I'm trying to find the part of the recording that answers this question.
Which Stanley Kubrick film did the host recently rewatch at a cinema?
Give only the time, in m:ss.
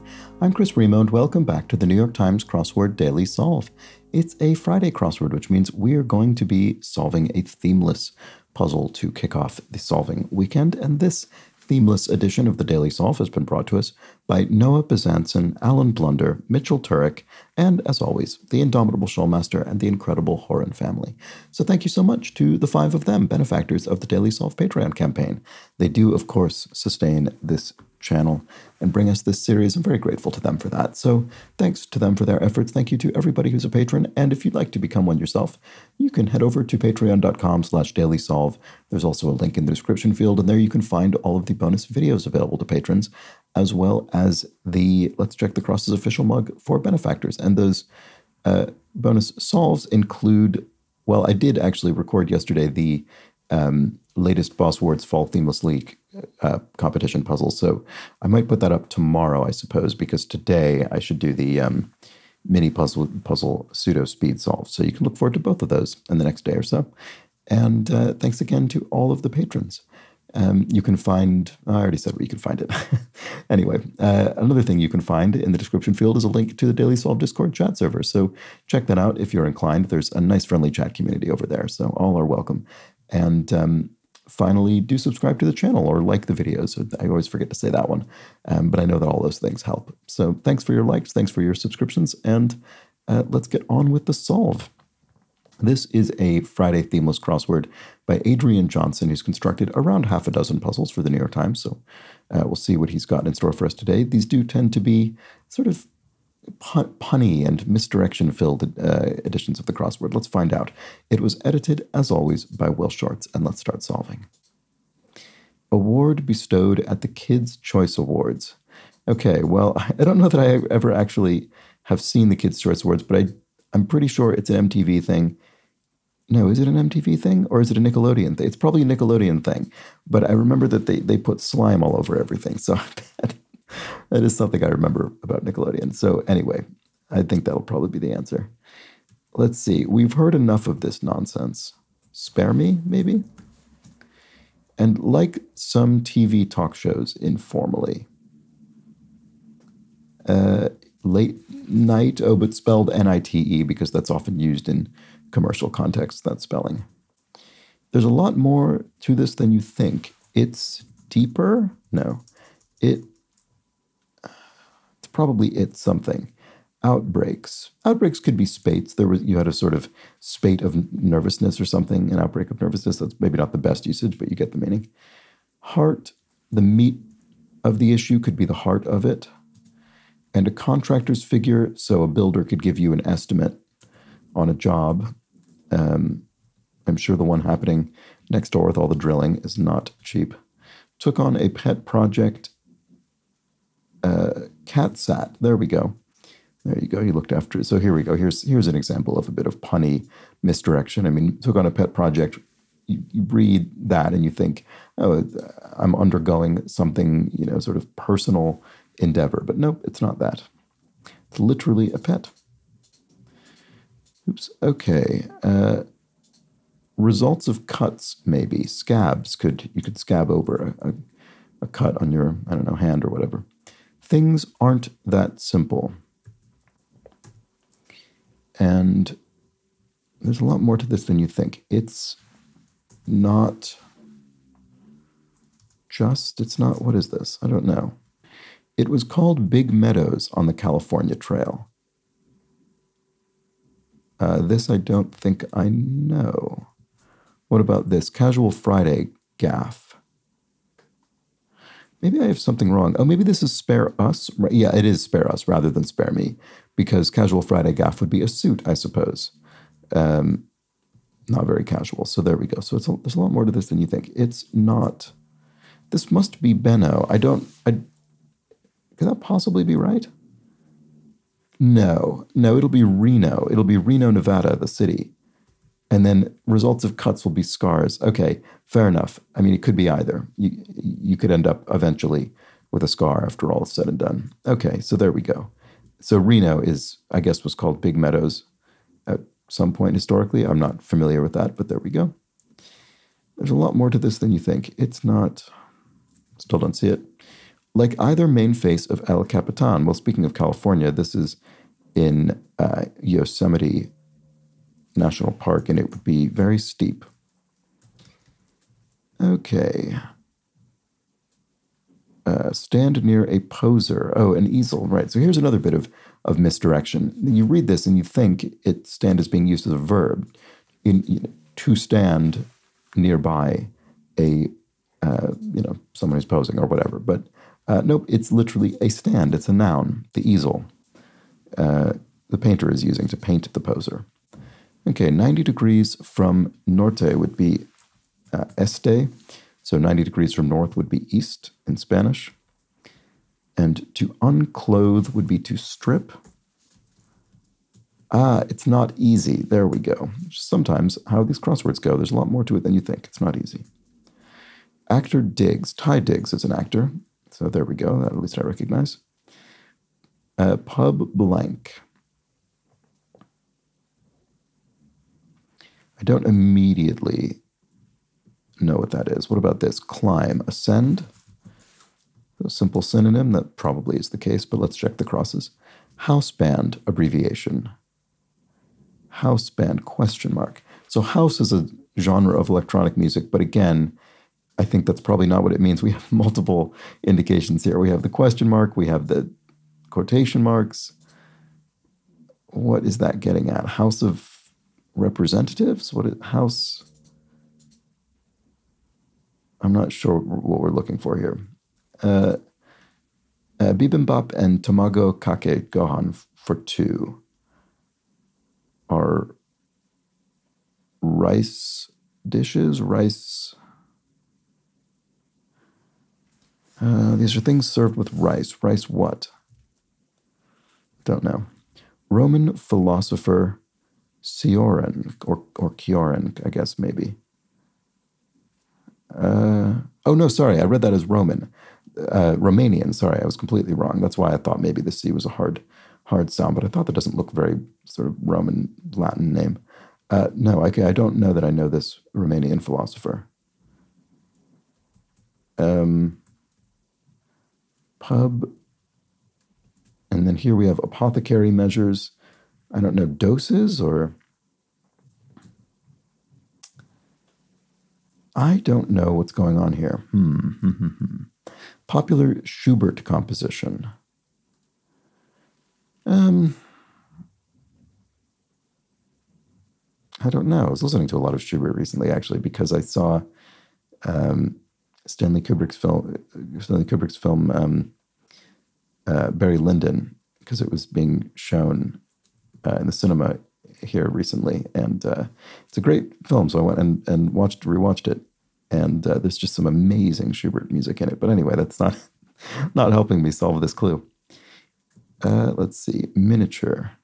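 7:59.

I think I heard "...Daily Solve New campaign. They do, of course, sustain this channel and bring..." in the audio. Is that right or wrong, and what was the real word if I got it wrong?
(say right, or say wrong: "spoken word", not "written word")
wrong: "Patreon", not "New".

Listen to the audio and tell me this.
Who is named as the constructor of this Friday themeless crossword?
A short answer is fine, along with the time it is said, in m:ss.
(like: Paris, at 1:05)
Adrian Johnson, at 1:38.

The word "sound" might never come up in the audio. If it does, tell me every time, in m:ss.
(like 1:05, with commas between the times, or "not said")
7:16.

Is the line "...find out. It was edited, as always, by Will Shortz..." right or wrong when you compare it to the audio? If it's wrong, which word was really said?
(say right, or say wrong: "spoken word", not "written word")
right.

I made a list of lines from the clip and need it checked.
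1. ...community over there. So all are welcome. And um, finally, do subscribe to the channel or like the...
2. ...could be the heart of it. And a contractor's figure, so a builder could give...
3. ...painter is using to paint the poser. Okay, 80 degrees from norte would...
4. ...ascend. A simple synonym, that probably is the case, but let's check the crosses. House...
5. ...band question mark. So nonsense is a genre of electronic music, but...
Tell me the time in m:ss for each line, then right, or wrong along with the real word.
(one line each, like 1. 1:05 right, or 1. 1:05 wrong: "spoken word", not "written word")
1. 1:20 right
2. 2:58 right
3. 5:32 wrong: "90", not "80"
4. 6:10 right
5. 6:19 wrong: "house", not "nonsense".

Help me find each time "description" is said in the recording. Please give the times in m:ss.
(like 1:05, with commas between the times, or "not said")
0:39, 1:15.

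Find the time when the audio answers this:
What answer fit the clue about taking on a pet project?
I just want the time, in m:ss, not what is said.
3:14.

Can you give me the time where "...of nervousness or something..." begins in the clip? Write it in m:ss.
2:50.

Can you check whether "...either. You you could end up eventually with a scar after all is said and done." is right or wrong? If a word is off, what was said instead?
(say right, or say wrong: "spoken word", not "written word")
right.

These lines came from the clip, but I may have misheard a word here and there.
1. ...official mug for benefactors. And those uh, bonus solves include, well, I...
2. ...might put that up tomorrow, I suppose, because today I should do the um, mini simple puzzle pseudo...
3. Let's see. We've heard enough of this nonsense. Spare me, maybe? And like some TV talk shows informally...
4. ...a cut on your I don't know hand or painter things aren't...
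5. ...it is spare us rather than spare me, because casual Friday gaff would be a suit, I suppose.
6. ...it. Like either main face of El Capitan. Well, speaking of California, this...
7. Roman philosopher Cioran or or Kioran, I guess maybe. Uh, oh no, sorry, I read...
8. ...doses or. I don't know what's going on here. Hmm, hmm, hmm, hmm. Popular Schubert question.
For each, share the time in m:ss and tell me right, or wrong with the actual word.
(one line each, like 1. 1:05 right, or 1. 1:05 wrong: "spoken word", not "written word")
1. 0:45 right
2. 0:58 wrong: "puzzle", not "simple"
3. 2:19 right
4. 3:41 wrong: "whatever", not "painter"
5. 4:14 right
6. 4:56 right
7. 7:02 right
8. 7:33 wrong: "composition", not "question".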